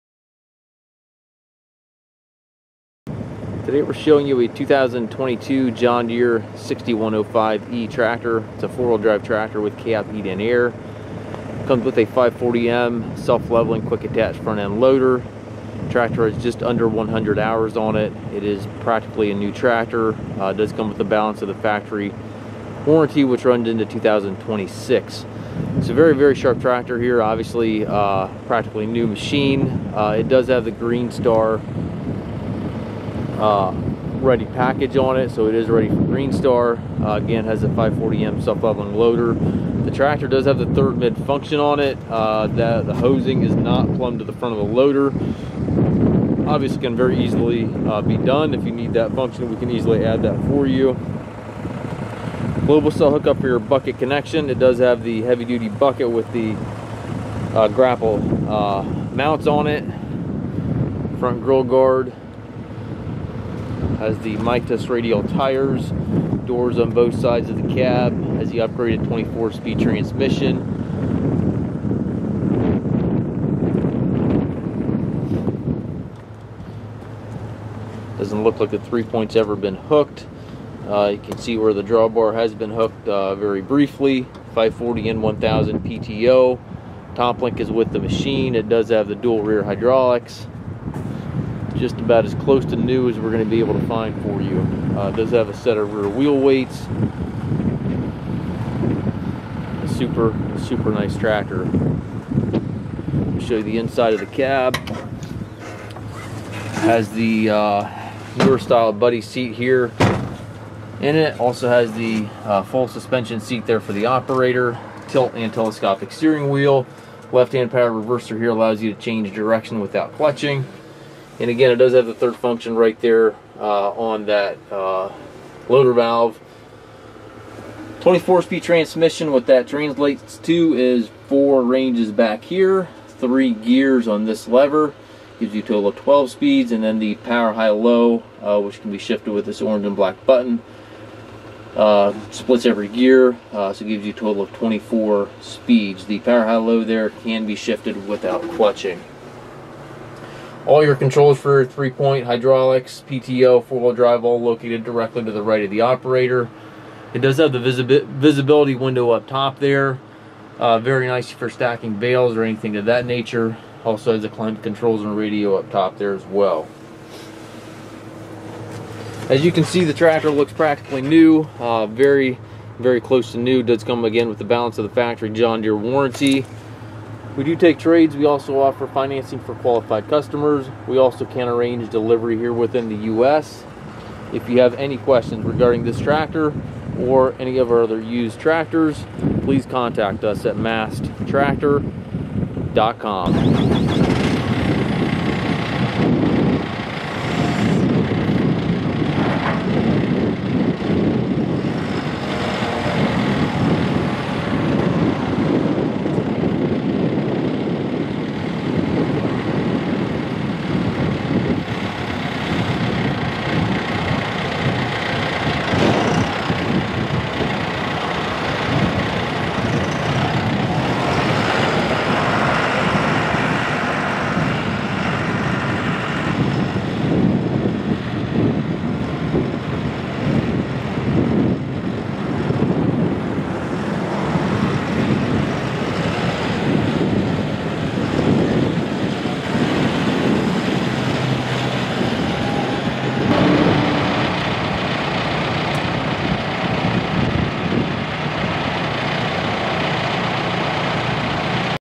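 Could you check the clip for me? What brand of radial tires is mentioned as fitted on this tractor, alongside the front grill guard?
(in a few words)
Mitas.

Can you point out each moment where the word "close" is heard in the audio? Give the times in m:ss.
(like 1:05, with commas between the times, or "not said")
1:32, 2:53.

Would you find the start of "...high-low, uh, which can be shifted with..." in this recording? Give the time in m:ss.
2:17.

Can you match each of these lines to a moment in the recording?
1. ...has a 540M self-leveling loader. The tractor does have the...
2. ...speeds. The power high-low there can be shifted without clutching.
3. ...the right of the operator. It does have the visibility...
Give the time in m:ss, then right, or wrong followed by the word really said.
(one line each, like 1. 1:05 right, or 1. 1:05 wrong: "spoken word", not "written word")
1. 0:37 right
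2. 2:25 right
3. 2:35 right.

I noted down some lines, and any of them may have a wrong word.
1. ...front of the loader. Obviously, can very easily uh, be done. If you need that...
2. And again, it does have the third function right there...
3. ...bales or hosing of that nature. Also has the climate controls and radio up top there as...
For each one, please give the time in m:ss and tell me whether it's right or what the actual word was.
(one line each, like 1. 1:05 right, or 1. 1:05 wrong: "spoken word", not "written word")
1. 0:44 right
2. 2:01 right
3. 2:41 wrong: "anything", not "hosing".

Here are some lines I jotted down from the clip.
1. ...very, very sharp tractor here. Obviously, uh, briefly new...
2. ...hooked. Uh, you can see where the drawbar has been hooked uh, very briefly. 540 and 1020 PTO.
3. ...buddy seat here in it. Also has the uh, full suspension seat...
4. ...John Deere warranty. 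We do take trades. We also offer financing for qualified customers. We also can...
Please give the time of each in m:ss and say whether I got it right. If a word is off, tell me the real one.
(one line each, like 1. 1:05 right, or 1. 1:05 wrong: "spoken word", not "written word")
1. 0:25 wrong: "practically", not "briefly"
2. 1:19 wrong: "1000", not "1020"
3. 1:48 right
4. 2:55 right.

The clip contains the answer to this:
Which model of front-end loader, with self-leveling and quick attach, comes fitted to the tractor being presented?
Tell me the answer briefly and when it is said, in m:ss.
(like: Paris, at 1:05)
540M, at 0:12.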